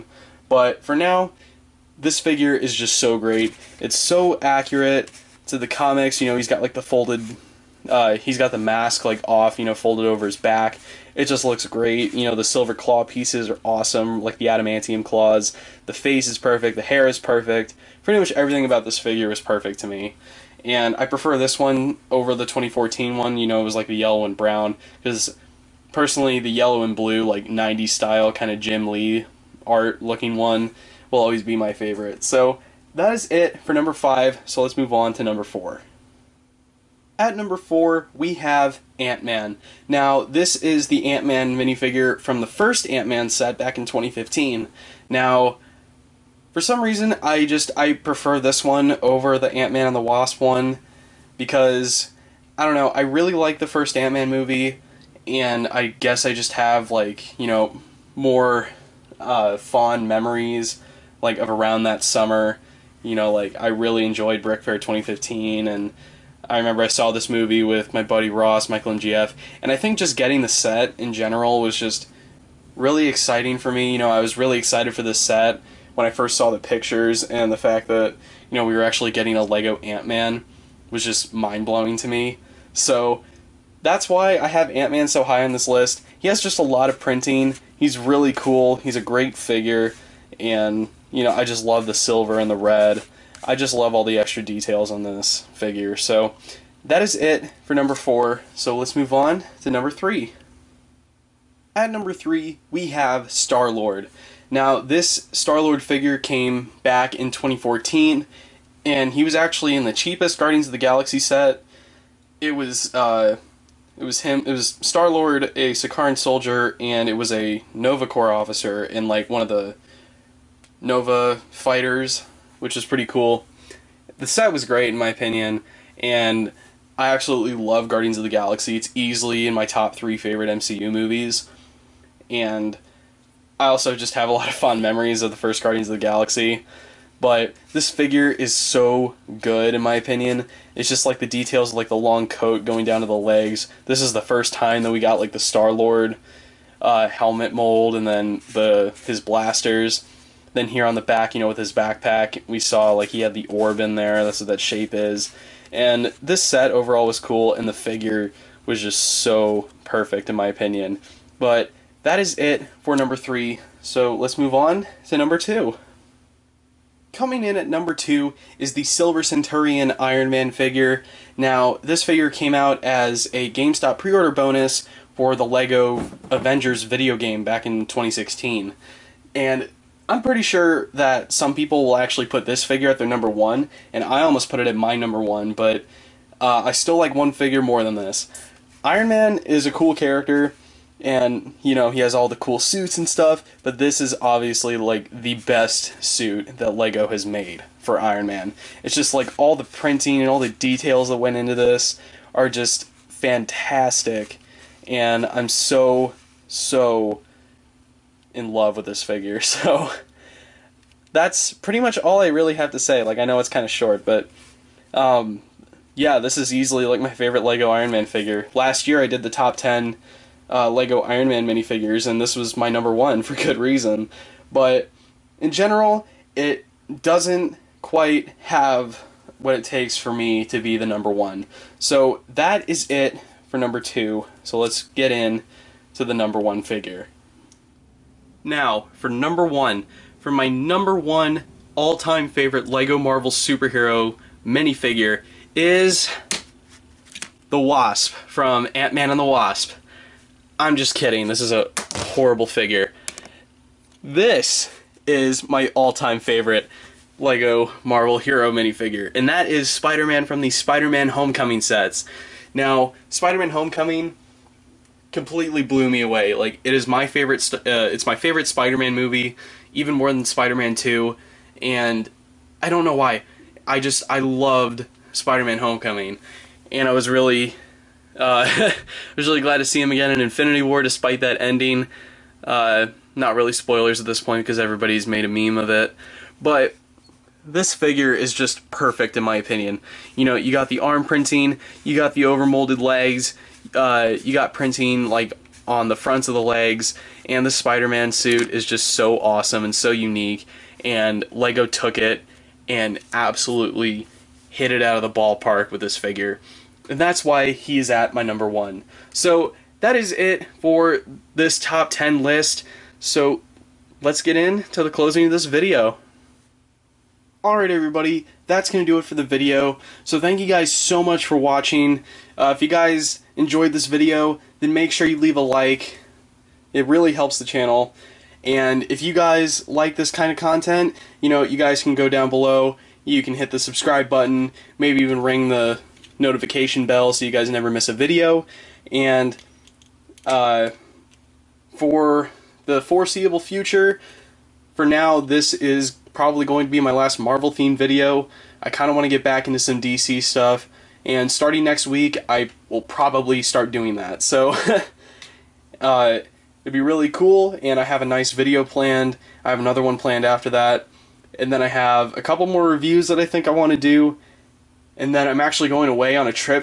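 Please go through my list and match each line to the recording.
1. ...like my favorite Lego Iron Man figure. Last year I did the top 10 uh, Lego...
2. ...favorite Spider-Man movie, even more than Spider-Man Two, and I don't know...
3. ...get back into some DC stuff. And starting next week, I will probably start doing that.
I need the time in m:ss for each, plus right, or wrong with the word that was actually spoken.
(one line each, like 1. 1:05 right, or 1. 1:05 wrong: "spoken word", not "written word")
1. 3:36 right
2. 4:28 right
3. 5:49 right.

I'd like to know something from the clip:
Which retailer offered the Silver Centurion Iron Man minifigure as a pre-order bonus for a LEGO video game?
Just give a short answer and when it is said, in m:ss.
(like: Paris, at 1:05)
GameStop, at 2:53.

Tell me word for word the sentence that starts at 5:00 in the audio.
And Lego took it and absolutely hit it out of the ballpark with this figure.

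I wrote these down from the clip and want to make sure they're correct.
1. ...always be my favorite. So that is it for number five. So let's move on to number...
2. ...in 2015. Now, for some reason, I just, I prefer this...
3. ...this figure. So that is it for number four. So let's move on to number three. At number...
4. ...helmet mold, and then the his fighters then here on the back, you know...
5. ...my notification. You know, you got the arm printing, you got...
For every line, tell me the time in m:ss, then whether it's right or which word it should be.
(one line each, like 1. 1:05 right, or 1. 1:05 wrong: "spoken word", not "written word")
1. 0:31 right
2. 0:43 right
3. 1:35 right
4. 2:27 wrong: "blasters", not "fighters"
5. 4:49 wrong: "opinion", not "notification".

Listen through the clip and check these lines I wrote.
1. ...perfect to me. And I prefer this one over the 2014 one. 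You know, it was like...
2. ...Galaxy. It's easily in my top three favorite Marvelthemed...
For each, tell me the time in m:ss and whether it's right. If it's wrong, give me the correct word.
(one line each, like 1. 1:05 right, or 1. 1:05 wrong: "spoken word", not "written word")
1. 0:19 right
2. 2:08 wrong: "MCU", not "Marvelthemed".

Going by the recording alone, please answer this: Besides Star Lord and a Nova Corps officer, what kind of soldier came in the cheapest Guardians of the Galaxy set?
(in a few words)
Sakaran soldier.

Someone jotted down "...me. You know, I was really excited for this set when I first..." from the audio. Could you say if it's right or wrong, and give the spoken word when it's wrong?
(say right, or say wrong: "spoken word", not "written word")
right.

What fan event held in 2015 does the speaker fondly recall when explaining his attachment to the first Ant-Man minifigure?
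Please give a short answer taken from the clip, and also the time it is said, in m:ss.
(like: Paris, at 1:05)
BrickFair 2015, at 1:04.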